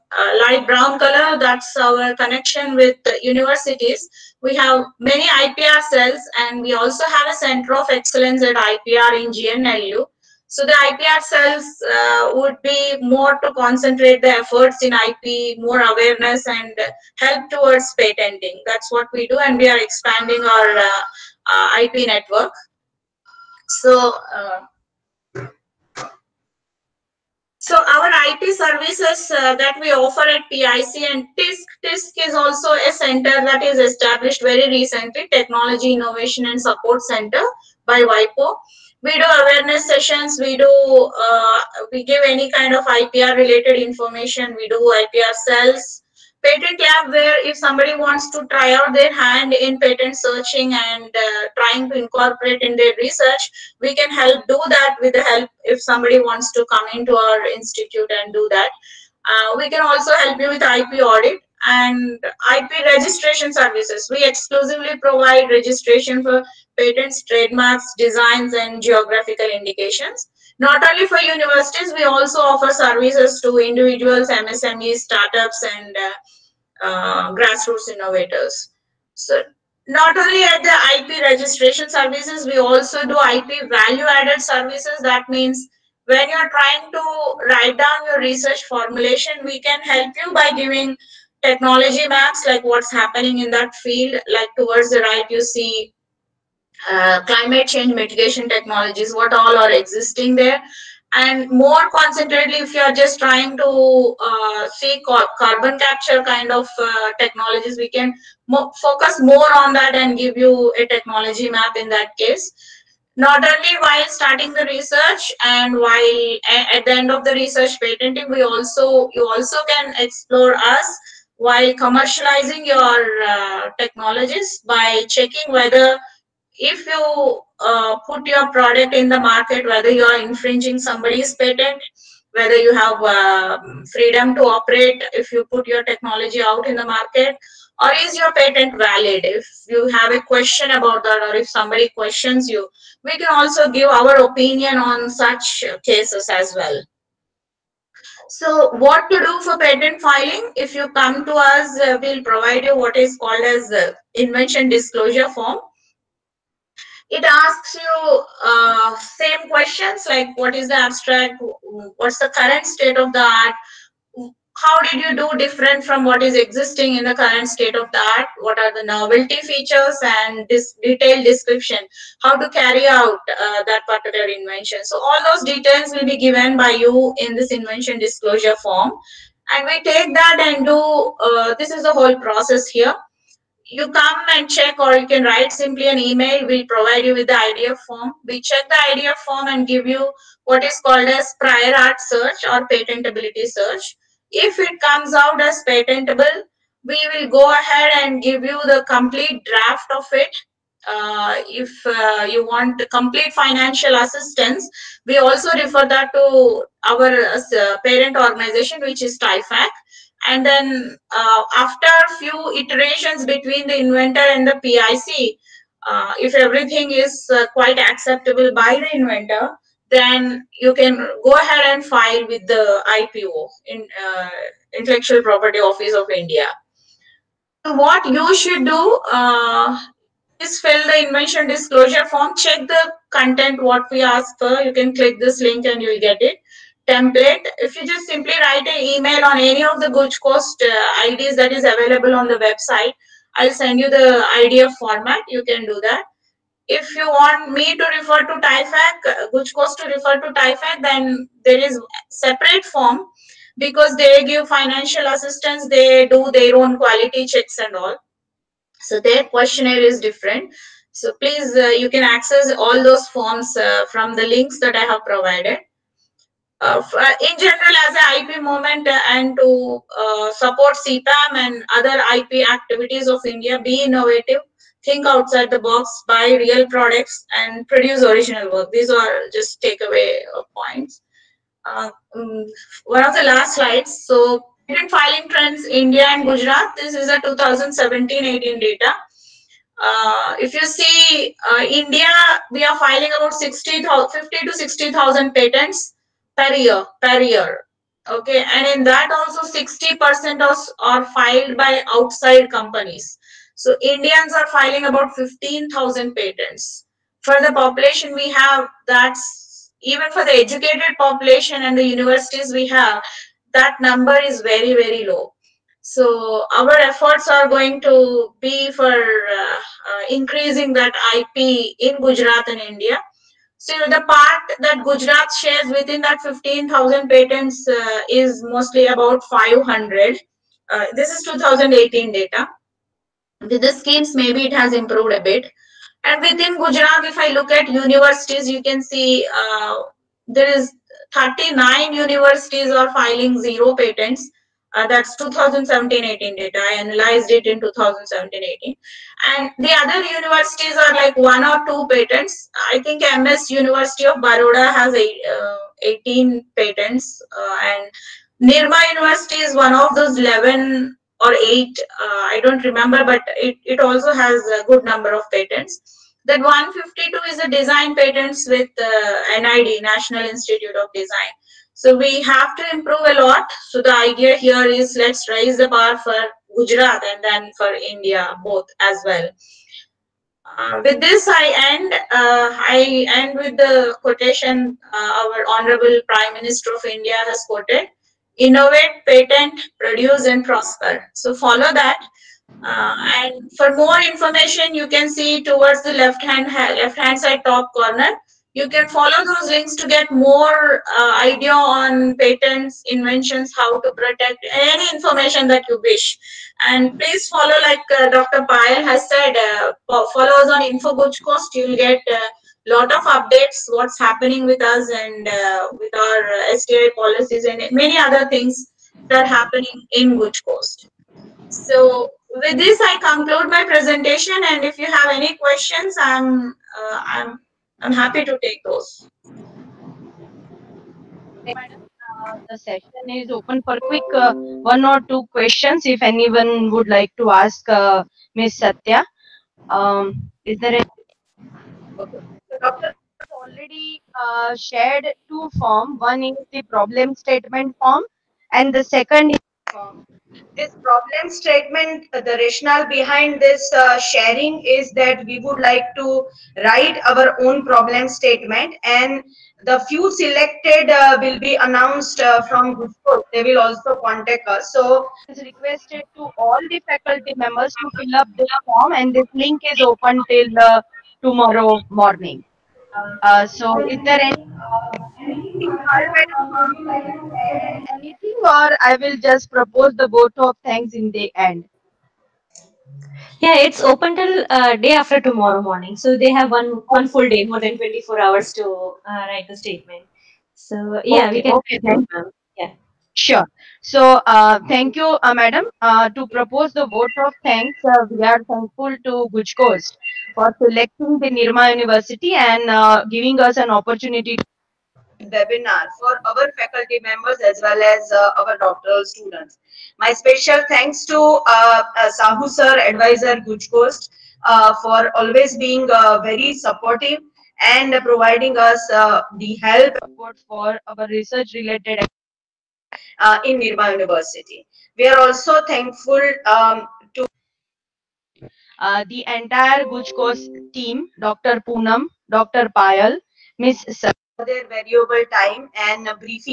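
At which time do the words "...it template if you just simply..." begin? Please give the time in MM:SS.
03:56.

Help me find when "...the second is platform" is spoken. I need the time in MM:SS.
07:28.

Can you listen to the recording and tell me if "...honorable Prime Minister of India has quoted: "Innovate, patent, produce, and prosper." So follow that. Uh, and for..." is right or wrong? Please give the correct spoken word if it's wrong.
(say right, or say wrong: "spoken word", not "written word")
right.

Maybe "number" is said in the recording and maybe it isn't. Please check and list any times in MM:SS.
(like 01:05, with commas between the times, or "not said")
05:13, 06:04.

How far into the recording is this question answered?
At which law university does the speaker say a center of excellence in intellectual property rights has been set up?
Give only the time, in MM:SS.
00:09.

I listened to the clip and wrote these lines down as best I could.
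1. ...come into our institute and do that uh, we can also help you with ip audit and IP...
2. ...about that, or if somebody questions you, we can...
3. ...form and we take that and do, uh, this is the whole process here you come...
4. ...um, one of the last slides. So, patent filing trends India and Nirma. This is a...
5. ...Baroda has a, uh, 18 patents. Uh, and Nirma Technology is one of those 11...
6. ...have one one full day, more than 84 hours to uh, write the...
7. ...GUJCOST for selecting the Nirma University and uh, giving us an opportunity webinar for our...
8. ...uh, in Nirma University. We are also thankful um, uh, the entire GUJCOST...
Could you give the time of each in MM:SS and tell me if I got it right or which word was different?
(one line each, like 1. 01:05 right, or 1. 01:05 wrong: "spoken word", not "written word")
1. 00:56 right
2. 02:20 right
3. 02:58 right
4. 04:42 wrong: "Gujarat", not "Nirma"
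5. 05:54 wrong: "University", not "Technology"
6. 08:06 wrong: "24", not "84"
7. 08:19 right
8. 08:43 right.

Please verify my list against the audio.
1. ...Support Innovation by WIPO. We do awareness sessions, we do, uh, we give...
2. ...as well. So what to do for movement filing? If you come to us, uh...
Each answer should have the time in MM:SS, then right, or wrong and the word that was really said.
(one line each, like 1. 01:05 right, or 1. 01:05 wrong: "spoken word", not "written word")
1. 00:36 wrong: "Center", not "Innovation"
2. 02:26 wrong: "patent", not "movement".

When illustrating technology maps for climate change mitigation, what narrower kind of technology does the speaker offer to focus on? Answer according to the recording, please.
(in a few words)
Carbon capture.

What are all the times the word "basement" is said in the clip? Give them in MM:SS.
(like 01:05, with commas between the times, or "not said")
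not said.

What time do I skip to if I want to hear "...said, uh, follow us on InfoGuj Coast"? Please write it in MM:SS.
06:49.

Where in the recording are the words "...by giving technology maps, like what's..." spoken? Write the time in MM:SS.
01:30.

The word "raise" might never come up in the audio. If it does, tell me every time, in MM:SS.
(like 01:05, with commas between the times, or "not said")
06:15.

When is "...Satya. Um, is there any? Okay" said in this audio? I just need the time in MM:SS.
07:18.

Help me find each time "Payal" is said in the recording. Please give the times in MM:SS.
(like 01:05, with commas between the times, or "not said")
06:48, 08:52.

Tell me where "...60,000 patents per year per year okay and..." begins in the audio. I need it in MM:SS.
04:54.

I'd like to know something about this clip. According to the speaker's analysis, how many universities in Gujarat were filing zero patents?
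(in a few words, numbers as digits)
39.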